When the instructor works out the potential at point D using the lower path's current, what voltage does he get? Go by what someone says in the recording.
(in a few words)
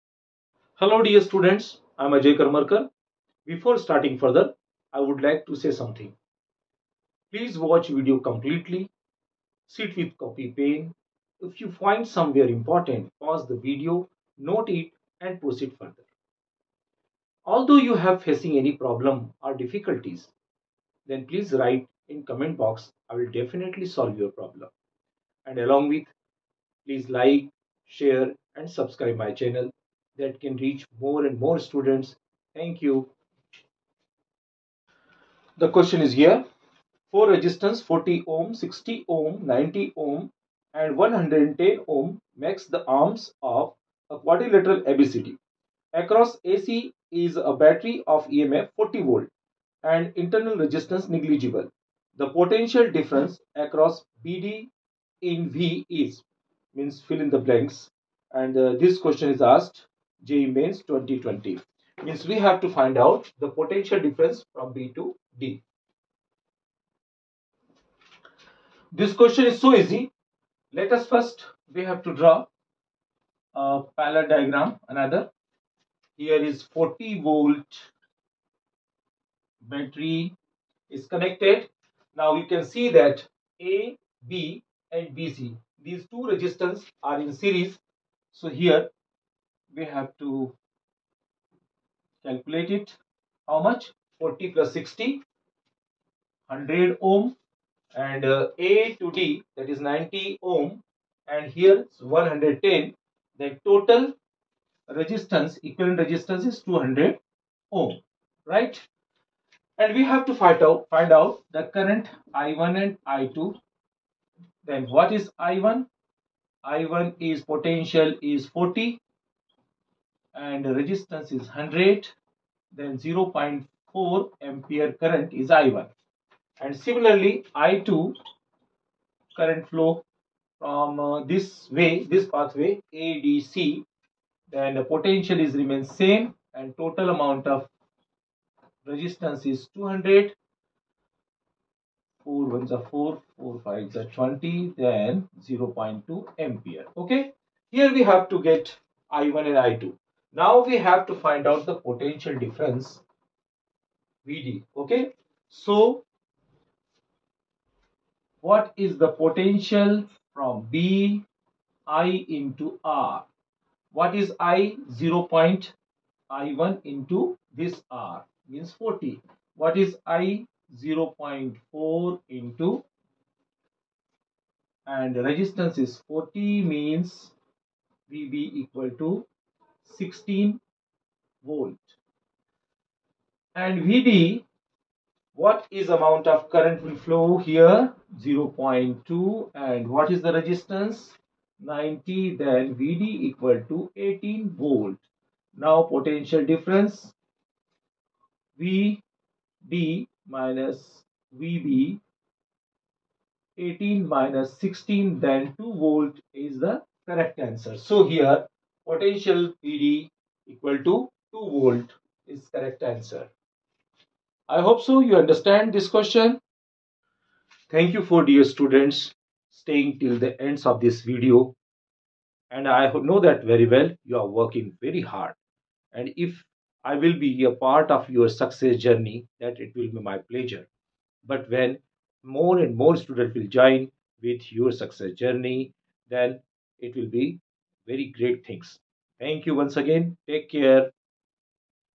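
18 volts.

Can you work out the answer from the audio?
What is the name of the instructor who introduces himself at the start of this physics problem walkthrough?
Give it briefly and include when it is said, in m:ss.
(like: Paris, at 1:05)
Ajay Karmarkar, at 0:02.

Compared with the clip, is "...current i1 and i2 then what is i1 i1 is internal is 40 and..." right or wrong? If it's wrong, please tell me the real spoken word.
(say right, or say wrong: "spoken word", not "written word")
wrong: "potential", not "internal".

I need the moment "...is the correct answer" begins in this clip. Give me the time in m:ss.
3:26.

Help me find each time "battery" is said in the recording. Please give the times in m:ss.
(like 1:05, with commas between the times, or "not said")
0:47, 1:19.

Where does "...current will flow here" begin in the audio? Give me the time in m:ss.
3:06.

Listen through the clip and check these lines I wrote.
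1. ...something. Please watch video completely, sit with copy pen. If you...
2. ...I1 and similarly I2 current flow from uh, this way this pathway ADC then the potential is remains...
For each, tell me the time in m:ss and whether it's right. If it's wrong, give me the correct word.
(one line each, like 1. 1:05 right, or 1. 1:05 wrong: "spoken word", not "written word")
1. 0:05 right
2. 2:05 right.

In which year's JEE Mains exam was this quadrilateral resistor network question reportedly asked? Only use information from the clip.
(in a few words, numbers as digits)
2020.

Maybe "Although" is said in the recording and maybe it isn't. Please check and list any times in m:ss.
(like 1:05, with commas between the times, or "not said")
0:17.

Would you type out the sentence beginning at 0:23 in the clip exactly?
I will definitely solve your problem.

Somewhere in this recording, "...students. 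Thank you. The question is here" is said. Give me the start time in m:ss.
0:31.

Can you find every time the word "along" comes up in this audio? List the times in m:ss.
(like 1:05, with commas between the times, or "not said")
0:25.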